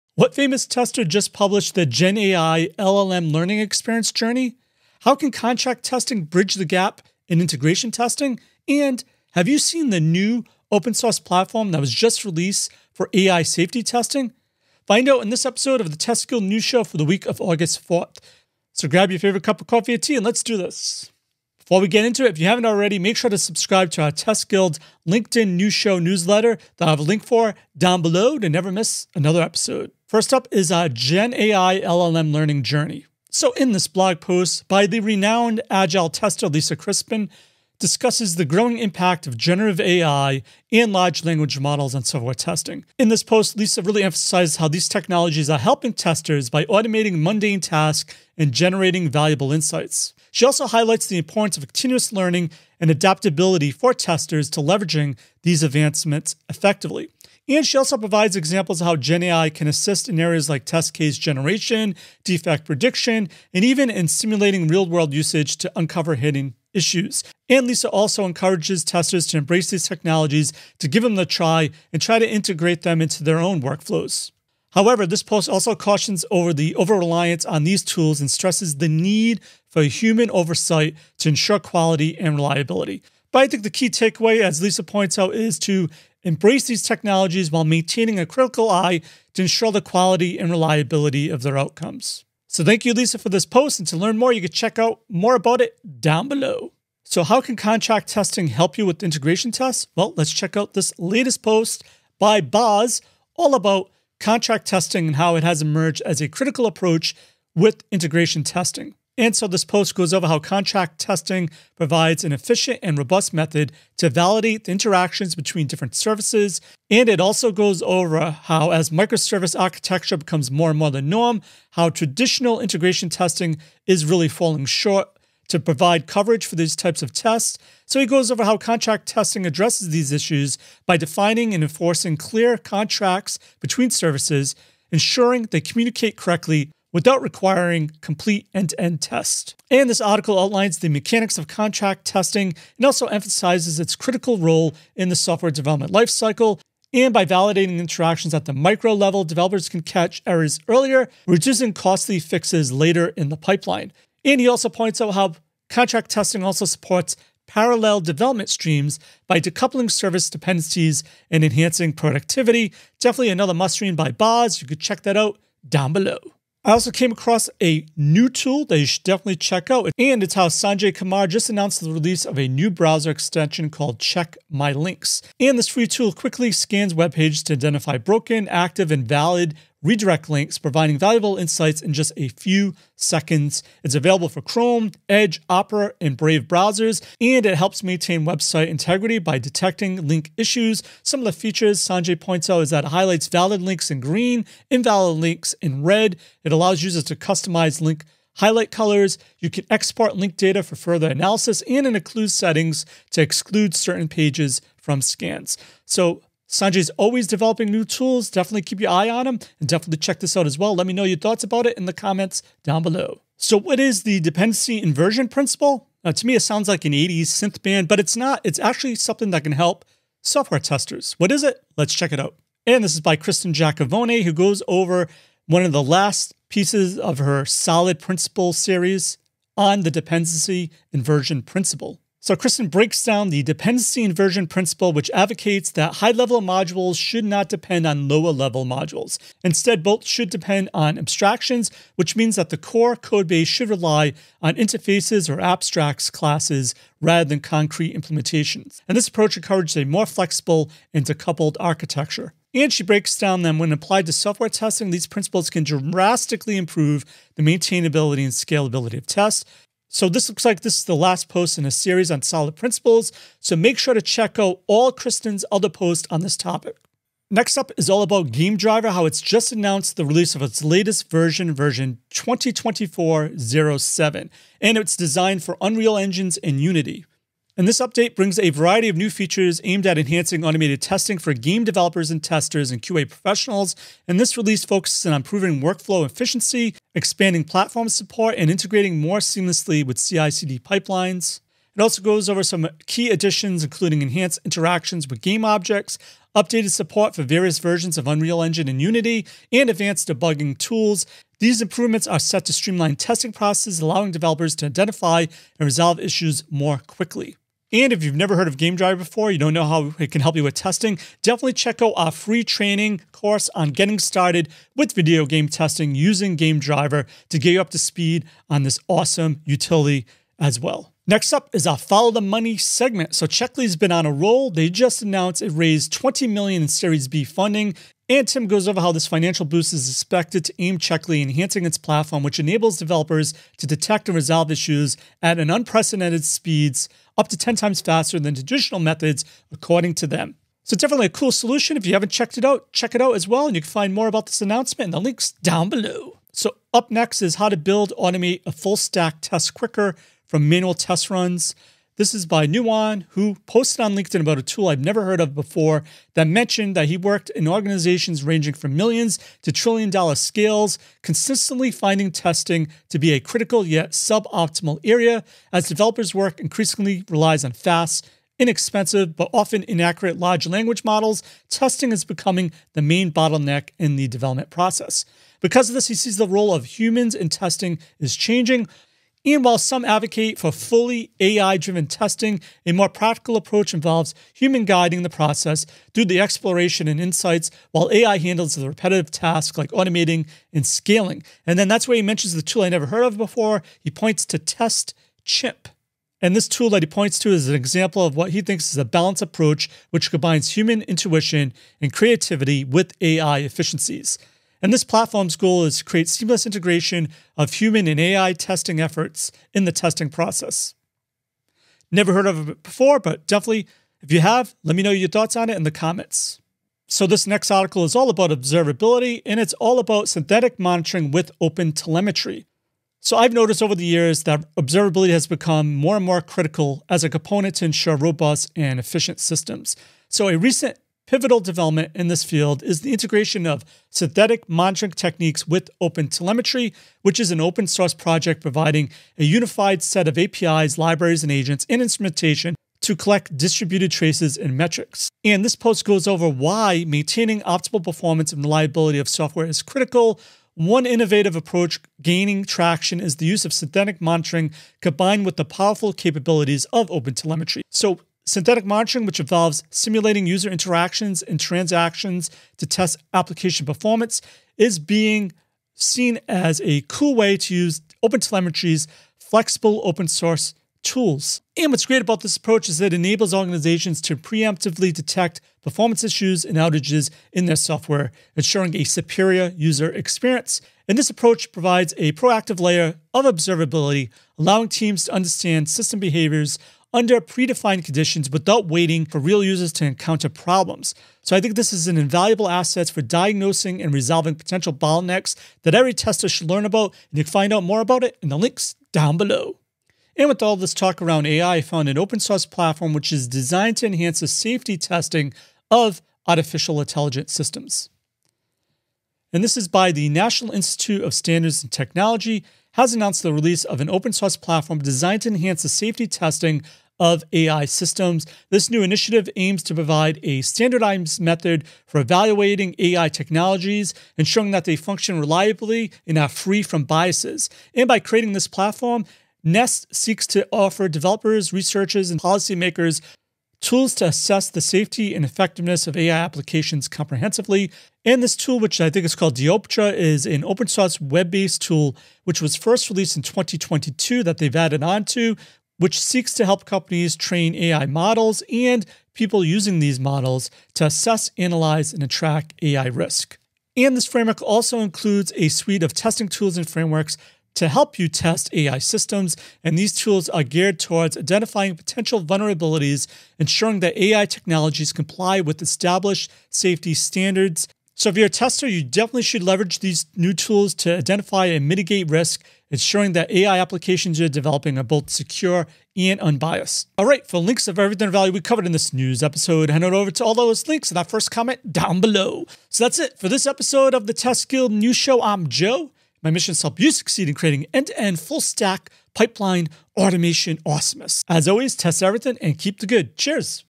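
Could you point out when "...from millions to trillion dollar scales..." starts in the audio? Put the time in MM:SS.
05:58.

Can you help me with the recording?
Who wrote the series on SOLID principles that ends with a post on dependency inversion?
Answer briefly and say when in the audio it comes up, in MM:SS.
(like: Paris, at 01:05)
Kristin Jackvony, at 03:43.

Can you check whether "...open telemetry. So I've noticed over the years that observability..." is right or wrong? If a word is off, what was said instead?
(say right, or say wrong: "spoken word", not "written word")
right.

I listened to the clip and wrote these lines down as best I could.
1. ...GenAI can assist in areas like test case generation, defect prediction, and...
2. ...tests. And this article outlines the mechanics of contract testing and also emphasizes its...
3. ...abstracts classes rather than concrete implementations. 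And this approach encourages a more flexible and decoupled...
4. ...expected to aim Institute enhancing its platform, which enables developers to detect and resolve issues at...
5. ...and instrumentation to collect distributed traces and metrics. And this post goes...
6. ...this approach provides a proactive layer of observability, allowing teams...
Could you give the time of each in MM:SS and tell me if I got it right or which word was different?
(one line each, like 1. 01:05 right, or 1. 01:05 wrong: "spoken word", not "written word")
1. 00:58 right
2. 02:19 right
3. 04:05 right
4. 05:29 wrong: "Checkly", not "Institute"
5. 07:21 right
6. 08:00 right.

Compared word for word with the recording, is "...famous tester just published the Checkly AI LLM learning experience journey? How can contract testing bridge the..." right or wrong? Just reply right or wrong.
wrong.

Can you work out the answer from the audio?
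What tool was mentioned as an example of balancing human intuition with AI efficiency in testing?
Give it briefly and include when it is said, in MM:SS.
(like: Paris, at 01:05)
Test Chimp, at 06:34.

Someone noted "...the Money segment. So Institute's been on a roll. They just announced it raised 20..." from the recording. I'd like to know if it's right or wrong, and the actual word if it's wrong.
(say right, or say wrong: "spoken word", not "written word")
wrong: "Checkly", not "Institute".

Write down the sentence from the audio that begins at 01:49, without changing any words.
And so this post goes over how contract testing provides an efficient and robust method to validate the interactions between different services.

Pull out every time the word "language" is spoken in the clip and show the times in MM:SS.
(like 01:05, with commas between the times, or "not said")
00:41, 06:10.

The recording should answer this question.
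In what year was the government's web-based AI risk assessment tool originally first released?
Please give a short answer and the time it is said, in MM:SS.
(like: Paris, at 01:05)
2022, at 09:03.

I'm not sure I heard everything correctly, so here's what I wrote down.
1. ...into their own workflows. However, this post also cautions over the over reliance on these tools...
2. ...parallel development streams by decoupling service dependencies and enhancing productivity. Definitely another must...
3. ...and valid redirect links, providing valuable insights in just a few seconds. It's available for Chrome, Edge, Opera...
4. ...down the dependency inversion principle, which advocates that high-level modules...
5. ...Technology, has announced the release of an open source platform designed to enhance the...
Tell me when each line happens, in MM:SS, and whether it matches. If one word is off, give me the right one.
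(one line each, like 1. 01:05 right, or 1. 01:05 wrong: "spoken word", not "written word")
1. 01:13 right
2. 02:37 right
3. 02:58 right
4. 03:53 right
5. 08:31 right.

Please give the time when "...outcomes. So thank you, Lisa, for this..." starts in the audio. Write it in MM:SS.
01:31.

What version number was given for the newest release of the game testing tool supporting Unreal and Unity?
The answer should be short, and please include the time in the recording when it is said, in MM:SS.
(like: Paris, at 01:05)
2024-07, at 04:32.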